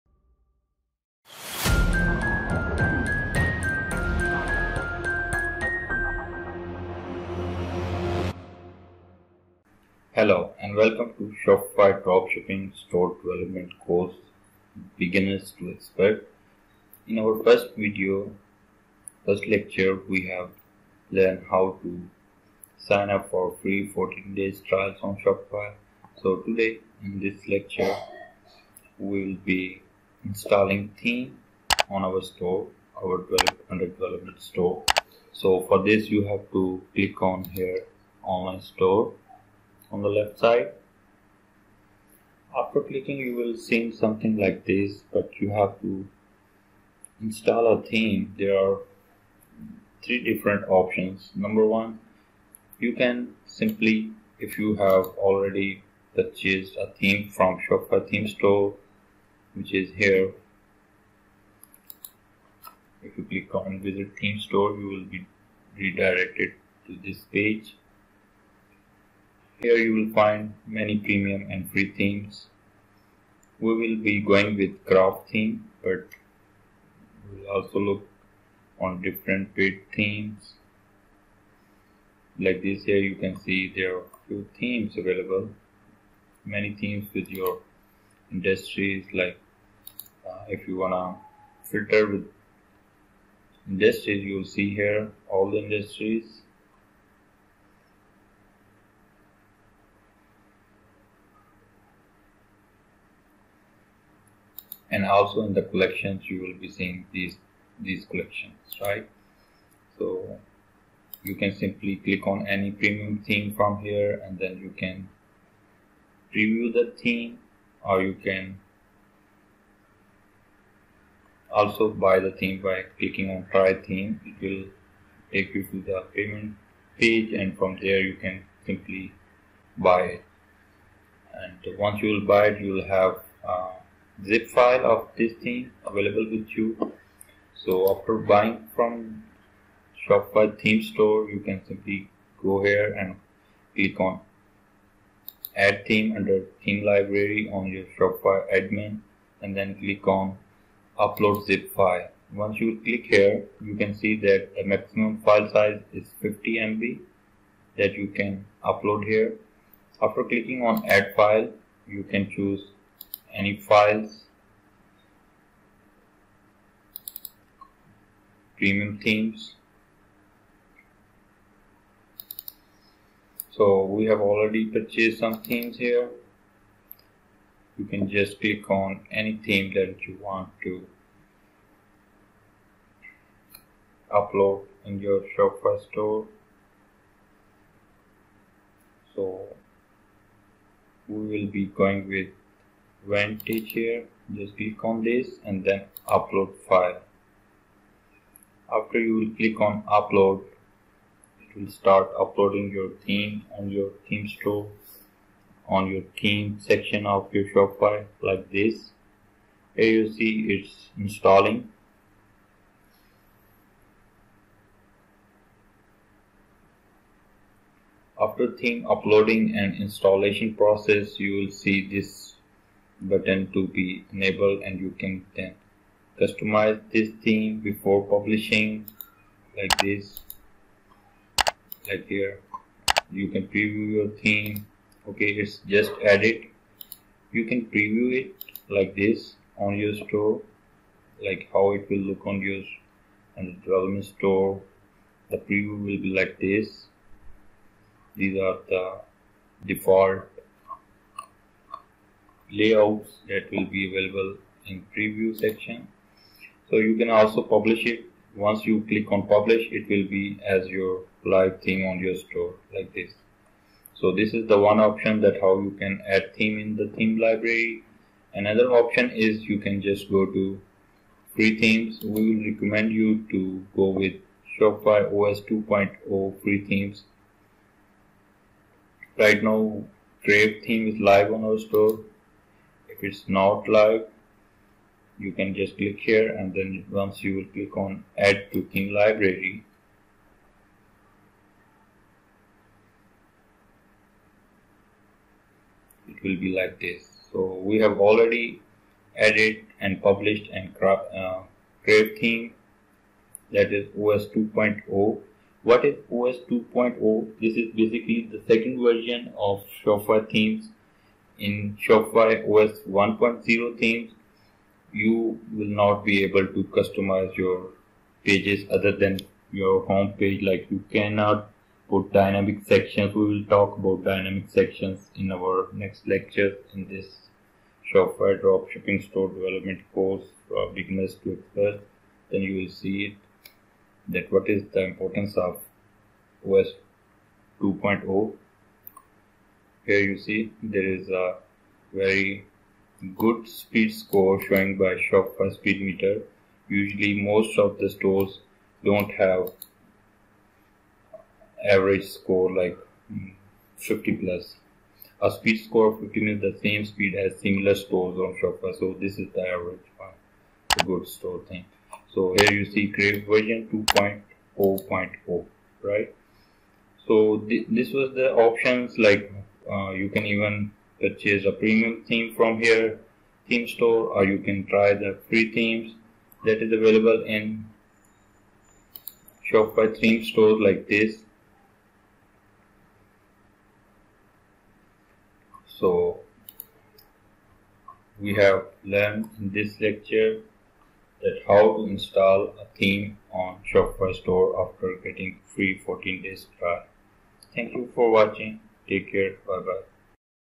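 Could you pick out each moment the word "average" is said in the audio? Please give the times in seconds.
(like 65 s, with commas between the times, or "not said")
351 s, 359 s.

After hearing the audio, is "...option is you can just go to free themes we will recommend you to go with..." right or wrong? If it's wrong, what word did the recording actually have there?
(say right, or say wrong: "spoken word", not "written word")
right.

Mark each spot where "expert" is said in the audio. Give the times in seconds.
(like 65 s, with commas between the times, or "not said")
15 s, 331 s.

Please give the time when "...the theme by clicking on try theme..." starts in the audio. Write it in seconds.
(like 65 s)
122 s.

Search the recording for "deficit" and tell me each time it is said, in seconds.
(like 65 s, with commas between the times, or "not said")
not said.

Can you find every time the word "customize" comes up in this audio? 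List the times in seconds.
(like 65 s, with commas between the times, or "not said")
226 s, 316 s.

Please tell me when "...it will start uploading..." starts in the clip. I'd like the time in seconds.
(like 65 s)
201 s.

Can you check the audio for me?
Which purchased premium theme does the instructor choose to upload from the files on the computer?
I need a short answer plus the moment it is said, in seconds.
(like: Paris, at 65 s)
Vantage, at 193 s.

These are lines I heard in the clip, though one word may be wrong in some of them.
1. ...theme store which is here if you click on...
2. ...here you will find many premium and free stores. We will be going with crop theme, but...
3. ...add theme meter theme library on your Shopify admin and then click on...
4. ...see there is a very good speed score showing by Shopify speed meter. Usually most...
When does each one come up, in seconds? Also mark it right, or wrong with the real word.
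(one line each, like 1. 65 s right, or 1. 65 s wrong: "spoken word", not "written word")
1. 58 s right
2. 69 s wrong: "themes", not "stores"
3. 145 s wrong: "under", not "meter"
4. 340 s right.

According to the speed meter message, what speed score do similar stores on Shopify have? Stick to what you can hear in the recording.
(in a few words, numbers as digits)
15.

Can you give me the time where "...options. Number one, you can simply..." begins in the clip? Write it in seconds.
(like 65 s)
50 s.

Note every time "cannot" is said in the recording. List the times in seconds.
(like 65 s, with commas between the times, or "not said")
320 s.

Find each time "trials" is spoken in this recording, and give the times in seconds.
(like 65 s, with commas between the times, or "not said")
24 s, 396 s.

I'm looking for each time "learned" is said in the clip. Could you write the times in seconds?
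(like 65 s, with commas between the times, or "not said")
21 s, 388 s.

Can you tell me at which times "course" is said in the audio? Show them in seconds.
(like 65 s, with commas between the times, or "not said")
13 s, 329 s.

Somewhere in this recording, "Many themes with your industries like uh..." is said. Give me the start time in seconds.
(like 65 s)
86 s.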